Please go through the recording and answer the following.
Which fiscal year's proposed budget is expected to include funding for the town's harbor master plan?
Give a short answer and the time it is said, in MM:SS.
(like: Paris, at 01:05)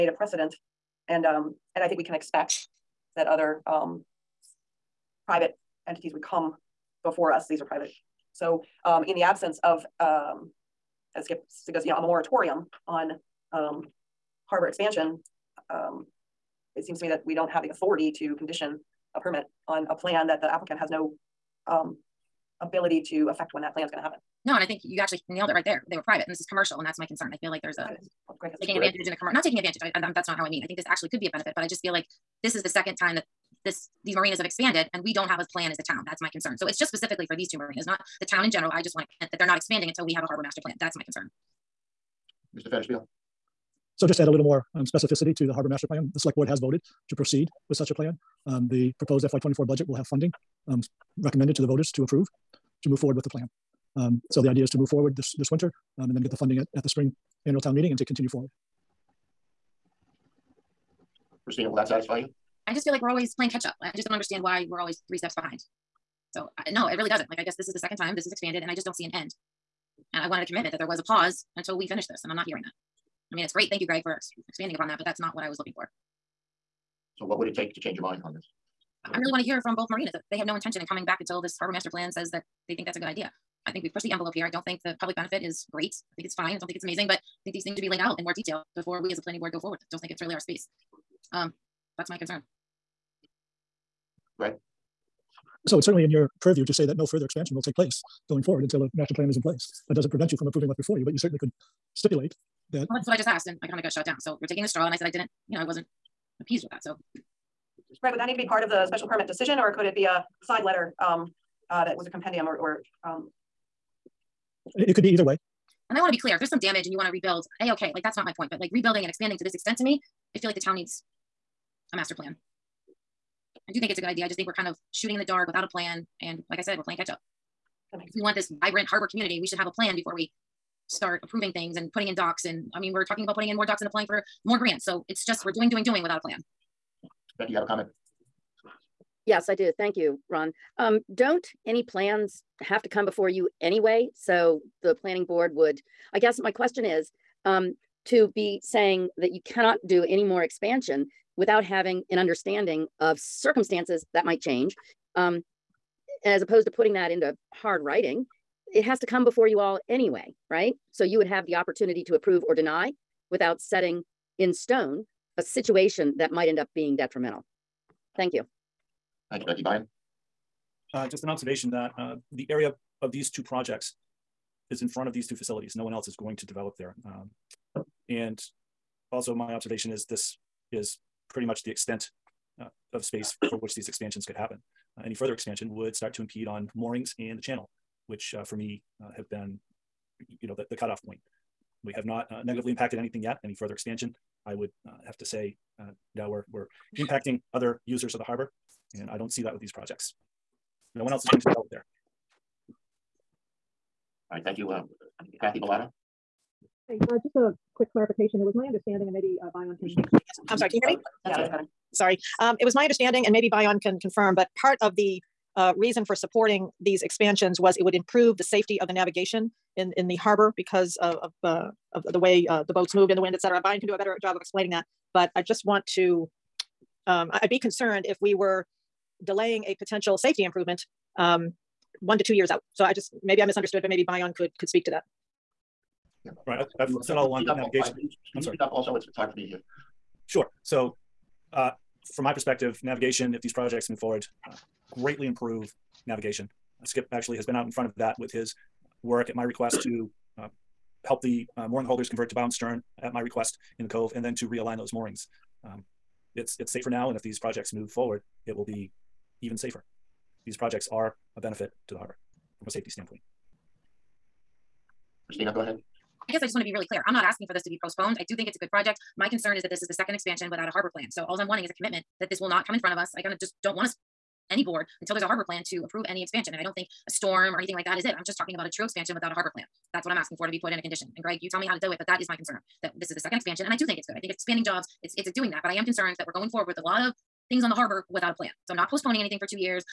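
FY24, at 00:49.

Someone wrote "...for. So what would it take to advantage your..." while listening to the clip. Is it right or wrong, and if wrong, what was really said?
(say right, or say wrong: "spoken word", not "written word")
wrong: "change", not "advantage".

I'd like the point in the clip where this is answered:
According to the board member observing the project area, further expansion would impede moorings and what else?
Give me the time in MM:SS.
03:07.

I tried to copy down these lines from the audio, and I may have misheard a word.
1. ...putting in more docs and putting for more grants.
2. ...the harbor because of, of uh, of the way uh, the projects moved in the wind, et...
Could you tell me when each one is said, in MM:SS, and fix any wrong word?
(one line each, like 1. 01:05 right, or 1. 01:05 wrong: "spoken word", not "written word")
1. 02:13 wrong: "applying", not "putting"
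2. 03:40 wrong: "boats", not "projects".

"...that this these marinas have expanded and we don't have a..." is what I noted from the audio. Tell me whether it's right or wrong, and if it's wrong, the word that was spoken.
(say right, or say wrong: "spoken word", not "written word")
right.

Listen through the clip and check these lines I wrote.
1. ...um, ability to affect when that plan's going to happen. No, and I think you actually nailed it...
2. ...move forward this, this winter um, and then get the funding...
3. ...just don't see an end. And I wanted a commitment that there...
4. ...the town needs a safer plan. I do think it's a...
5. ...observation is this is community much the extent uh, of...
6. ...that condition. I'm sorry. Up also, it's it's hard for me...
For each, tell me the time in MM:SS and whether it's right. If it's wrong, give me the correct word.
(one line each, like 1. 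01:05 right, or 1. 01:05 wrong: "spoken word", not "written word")
1. 00:21 right
2. 00:54 right
3. 01:08 right
4. 02:00 wrong: "master", not "safer"
5. 02:59 wrong: "pretty", not "community"
6. 03:57 wrong: "navigation", not "condition".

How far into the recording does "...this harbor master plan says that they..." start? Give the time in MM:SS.
01:21.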